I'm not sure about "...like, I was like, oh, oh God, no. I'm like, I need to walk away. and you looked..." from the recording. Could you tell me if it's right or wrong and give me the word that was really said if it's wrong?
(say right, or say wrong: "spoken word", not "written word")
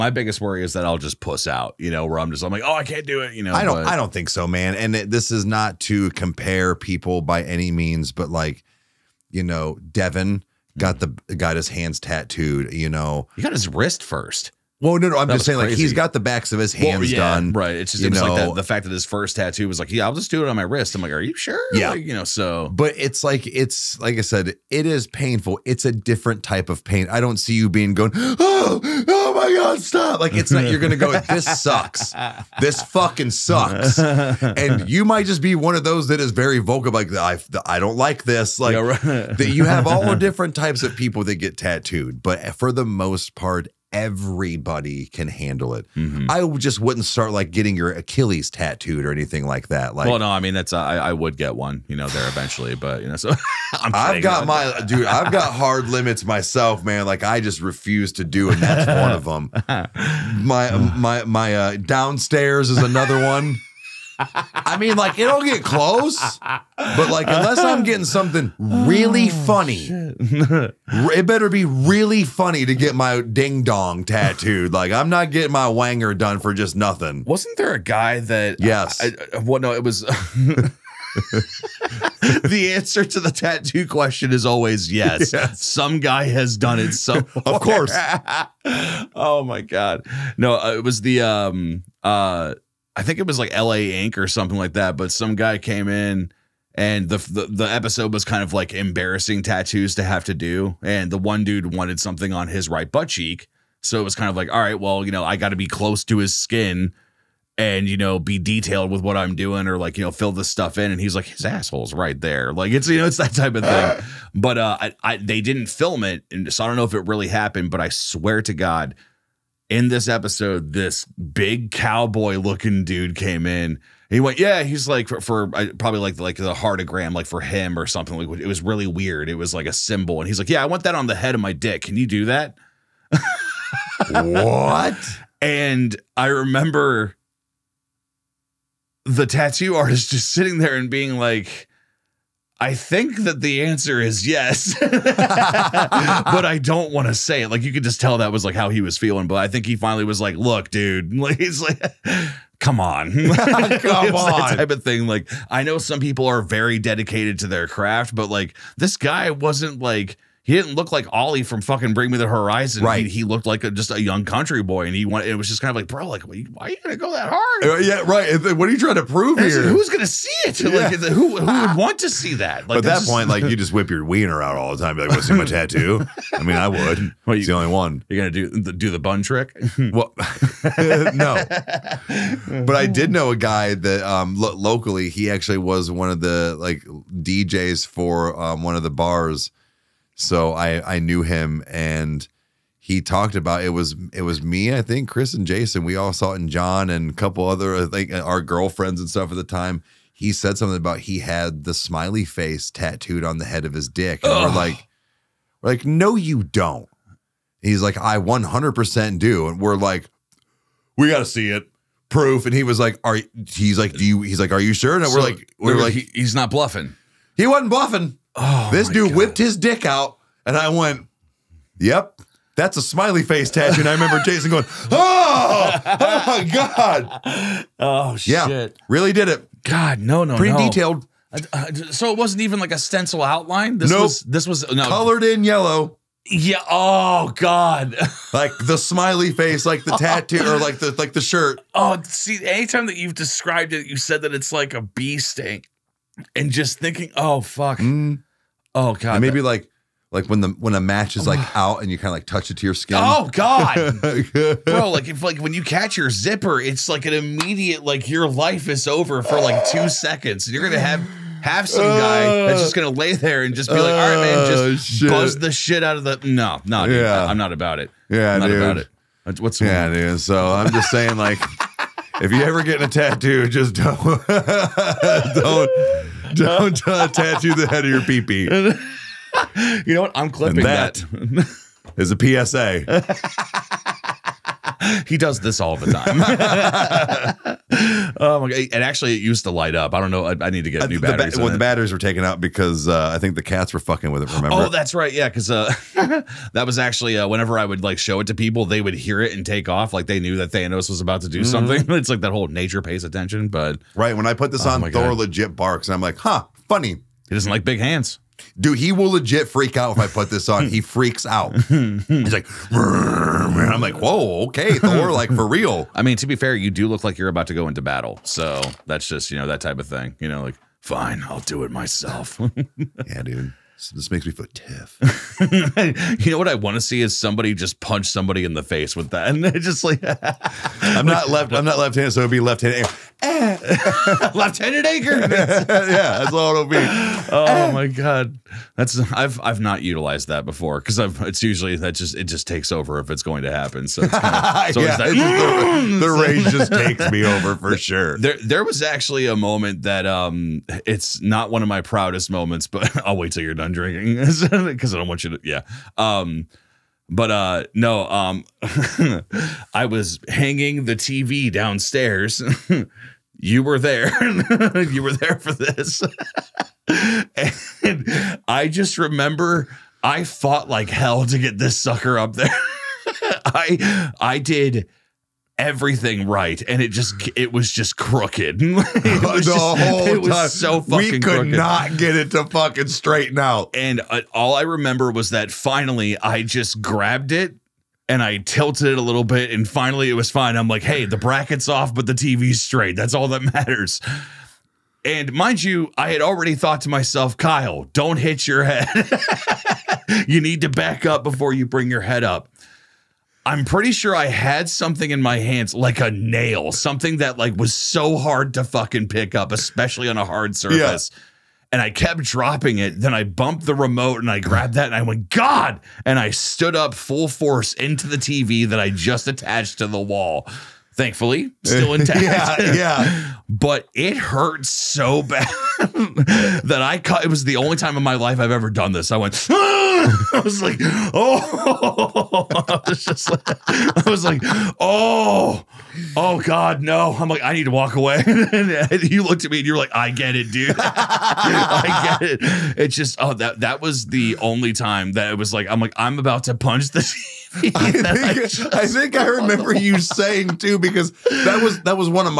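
right.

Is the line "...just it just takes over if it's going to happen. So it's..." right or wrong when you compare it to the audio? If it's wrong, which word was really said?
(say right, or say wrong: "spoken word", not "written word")
right.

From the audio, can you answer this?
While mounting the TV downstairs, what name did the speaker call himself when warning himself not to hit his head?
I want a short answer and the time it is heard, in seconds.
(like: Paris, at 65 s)
Kyle, at 397 s.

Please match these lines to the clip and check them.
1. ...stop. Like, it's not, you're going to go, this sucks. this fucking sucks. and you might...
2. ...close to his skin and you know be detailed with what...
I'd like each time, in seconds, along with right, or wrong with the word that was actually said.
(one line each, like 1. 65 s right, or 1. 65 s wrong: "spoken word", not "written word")
1. 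29 s right
2. 105 s right.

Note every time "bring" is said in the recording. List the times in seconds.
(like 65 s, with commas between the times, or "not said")
161 s, 401 s.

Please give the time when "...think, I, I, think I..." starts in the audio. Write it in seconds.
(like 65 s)
447 s.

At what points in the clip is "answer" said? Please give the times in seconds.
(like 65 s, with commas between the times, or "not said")
82 s, 143 s.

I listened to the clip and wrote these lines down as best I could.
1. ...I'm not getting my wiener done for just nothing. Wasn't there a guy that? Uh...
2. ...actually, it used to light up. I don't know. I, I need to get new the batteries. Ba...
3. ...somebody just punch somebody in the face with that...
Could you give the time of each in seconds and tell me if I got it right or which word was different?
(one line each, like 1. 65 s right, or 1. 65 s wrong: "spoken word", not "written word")
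1. 74 s wrong: "wanger", not "wiener"
2. 288 s right
3. 327 s right.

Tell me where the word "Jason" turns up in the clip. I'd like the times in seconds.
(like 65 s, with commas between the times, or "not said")
195 s, 224 s.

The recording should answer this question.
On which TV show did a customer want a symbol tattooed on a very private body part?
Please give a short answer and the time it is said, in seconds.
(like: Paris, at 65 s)
LA Ink, at 93 s.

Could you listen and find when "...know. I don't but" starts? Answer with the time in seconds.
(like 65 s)
3 s.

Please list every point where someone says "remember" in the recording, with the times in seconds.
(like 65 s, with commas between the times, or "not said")
136 s, 223 s, 294 s, 368 s, 384 s, 449 s.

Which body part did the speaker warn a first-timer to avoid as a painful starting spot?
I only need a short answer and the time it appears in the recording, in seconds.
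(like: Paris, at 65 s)
Achilles, at 47 s.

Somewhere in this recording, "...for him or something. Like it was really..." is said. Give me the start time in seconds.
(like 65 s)
127 s.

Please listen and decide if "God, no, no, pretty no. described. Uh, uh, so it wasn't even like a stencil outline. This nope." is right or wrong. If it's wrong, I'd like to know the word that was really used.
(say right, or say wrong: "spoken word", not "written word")
wrong: "detailed", not "described".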